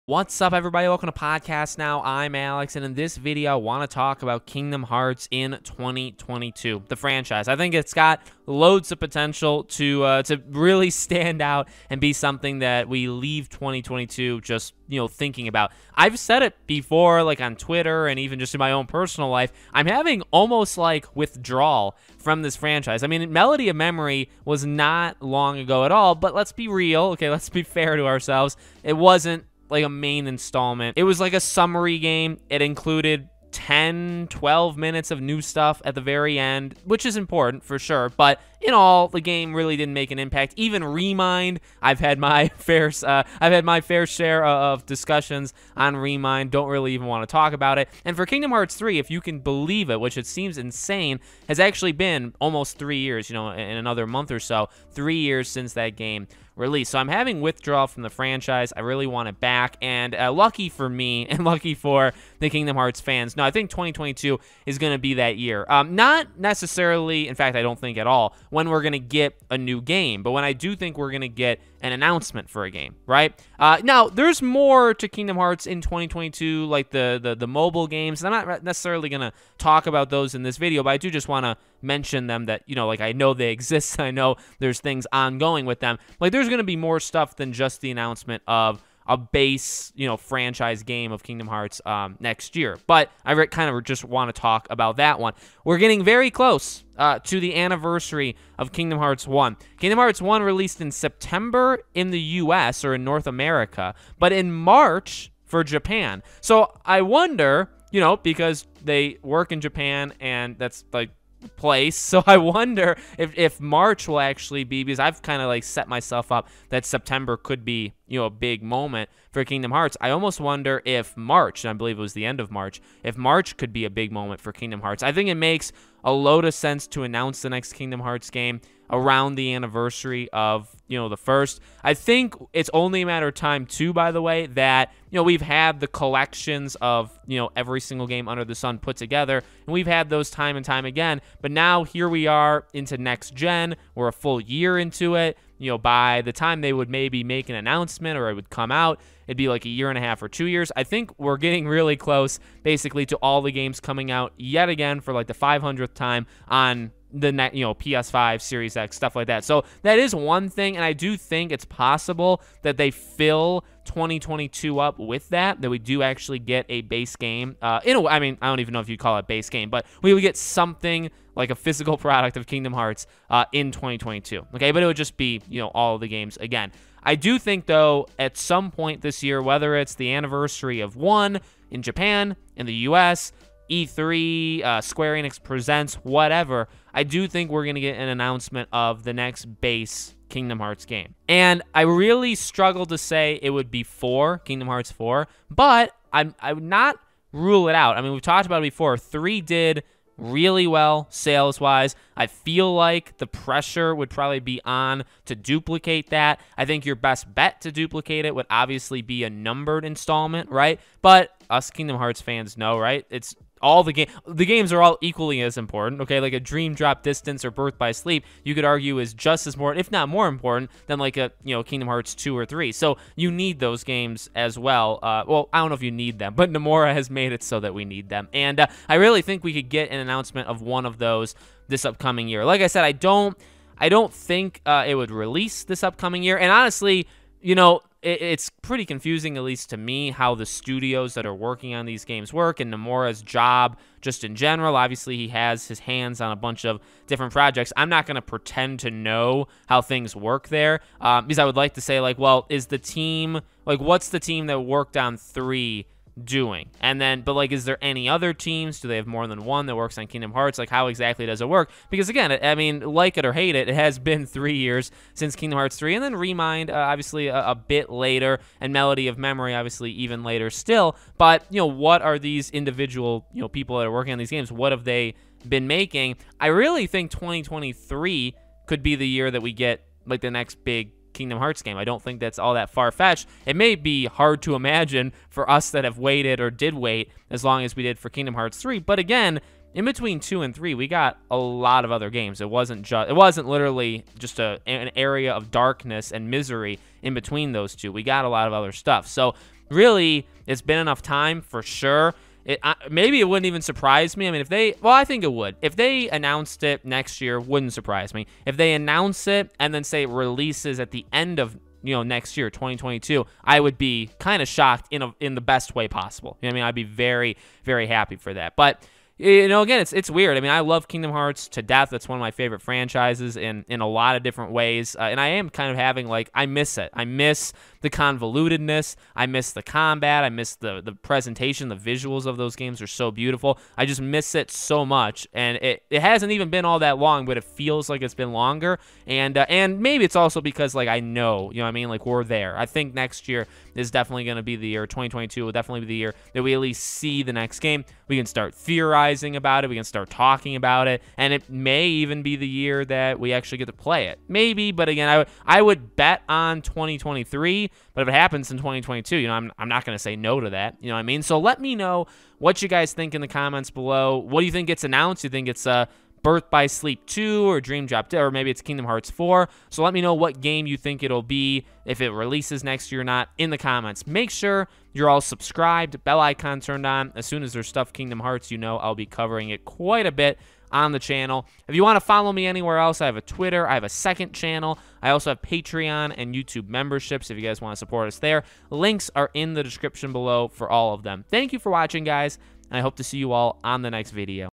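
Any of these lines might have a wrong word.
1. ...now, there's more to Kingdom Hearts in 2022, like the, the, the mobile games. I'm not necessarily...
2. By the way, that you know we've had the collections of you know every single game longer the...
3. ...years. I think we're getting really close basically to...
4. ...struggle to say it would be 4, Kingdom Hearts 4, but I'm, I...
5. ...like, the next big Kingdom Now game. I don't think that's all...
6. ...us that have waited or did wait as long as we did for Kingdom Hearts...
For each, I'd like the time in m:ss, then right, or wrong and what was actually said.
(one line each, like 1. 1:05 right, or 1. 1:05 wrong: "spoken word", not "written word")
1. 1:13 right
2. 2:13 wrong: "under", not "longer"
3. 2:30 right
4. 3:12 right
5. 4:40 wrong: "Hearts", not "Now"
6. 4:45 right.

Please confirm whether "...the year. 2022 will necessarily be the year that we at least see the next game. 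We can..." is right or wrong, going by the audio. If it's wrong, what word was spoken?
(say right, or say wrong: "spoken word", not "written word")
wrong: "definitely", not "necessarily".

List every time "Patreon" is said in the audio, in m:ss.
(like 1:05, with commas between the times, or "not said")
6:25.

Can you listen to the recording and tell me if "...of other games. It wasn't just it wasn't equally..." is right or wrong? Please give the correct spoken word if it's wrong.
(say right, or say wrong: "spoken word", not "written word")
wrong: "literally", not "equally".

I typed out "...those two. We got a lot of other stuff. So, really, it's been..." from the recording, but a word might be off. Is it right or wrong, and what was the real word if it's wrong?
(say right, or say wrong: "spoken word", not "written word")
right.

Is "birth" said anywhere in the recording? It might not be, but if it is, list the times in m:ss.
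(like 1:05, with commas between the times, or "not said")
3:37, 6:06.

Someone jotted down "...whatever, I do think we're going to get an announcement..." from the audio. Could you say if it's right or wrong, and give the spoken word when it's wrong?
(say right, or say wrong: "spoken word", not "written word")
right.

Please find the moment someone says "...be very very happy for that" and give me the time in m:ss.
5:16.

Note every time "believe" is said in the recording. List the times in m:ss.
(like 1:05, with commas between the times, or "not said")
0:49, 2:01.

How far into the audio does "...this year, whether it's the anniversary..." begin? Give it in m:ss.
2:59.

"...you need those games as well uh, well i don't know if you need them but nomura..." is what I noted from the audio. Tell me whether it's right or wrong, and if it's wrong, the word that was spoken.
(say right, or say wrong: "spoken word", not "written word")
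right.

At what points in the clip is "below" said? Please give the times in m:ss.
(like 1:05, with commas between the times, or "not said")
6:03, 6:30.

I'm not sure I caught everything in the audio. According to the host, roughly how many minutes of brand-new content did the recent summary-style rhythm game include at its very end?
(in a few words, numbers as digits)
10 to 12 minutes.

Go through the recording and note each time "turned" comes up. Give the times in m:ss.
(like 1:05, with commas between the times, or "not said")
6:16.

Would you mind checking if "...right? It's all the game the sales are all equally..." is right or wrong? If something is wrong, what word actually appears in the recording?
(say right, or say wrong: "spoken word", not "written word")
wrong: "games", not "sales".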